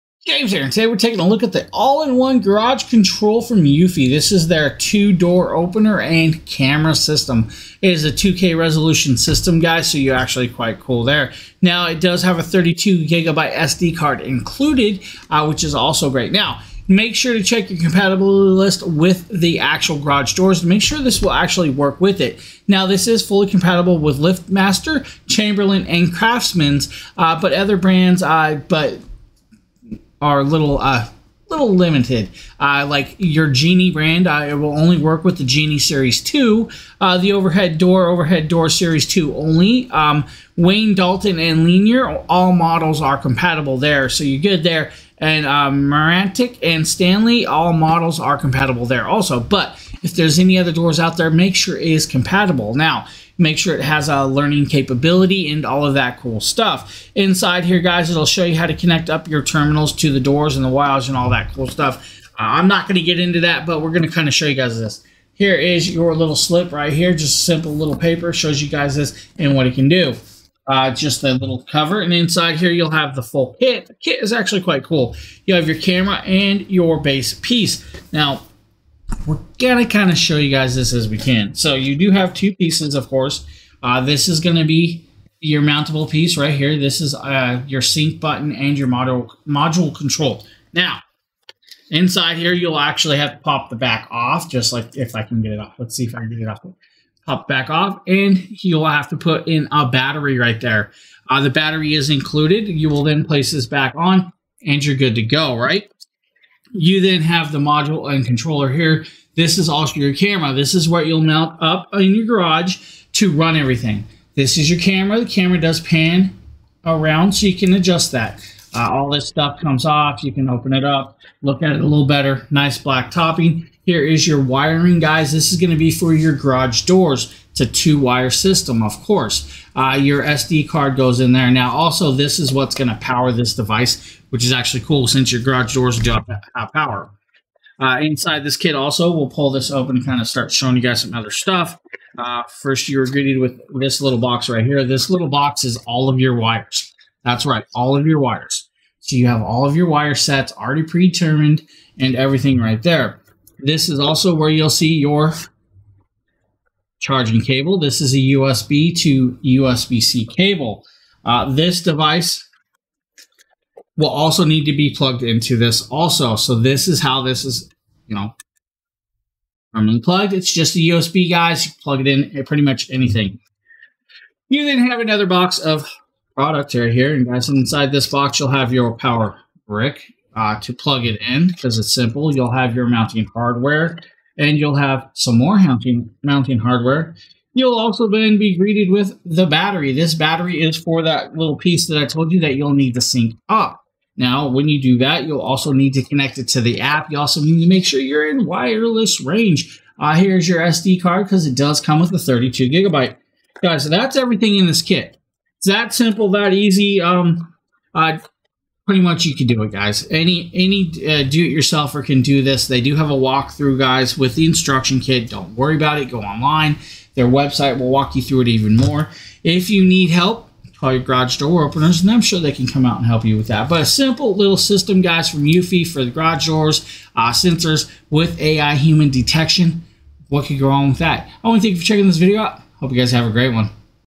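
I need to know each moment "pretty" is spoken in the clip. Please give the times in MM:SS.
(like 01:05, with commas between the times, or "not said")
02:52, 03:28.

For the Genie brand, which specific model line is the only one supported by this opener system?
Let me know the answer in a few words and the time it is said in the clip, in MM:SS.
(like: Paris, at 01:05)
Genie Series 2, at 00:35.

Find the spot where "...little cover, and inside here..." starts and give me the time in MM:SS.
01:11.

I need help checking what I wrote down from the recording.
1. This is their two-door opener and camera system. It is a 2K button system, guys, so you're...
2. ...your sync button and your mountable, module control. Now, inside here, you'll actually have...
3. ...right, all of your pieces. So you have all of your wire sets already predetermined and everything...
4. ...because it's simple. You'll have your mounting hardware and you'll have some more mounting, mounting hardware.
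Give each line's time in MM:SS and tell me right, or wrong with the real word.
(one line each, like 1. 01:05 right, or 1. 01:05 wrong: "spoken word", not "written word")
1. 00:04 wrong: "resolution", not "button"
2. 01:27 wrong: "module", not "mountable"
3. 02:27 wrong: "wires", not "pieces"
4. 03:01 right.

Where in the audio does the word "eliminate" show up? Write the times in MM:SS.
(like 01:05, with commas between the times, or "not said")
not said.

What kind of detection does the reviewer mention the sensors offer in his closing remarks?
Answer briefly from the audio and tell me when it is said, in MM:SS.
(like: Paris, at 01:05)
AI human detection, at 03:48.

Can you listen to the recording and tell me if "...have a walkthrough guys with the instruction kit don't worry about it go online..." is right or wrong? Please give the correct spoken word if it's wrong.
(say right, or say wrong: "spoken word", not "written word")
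right.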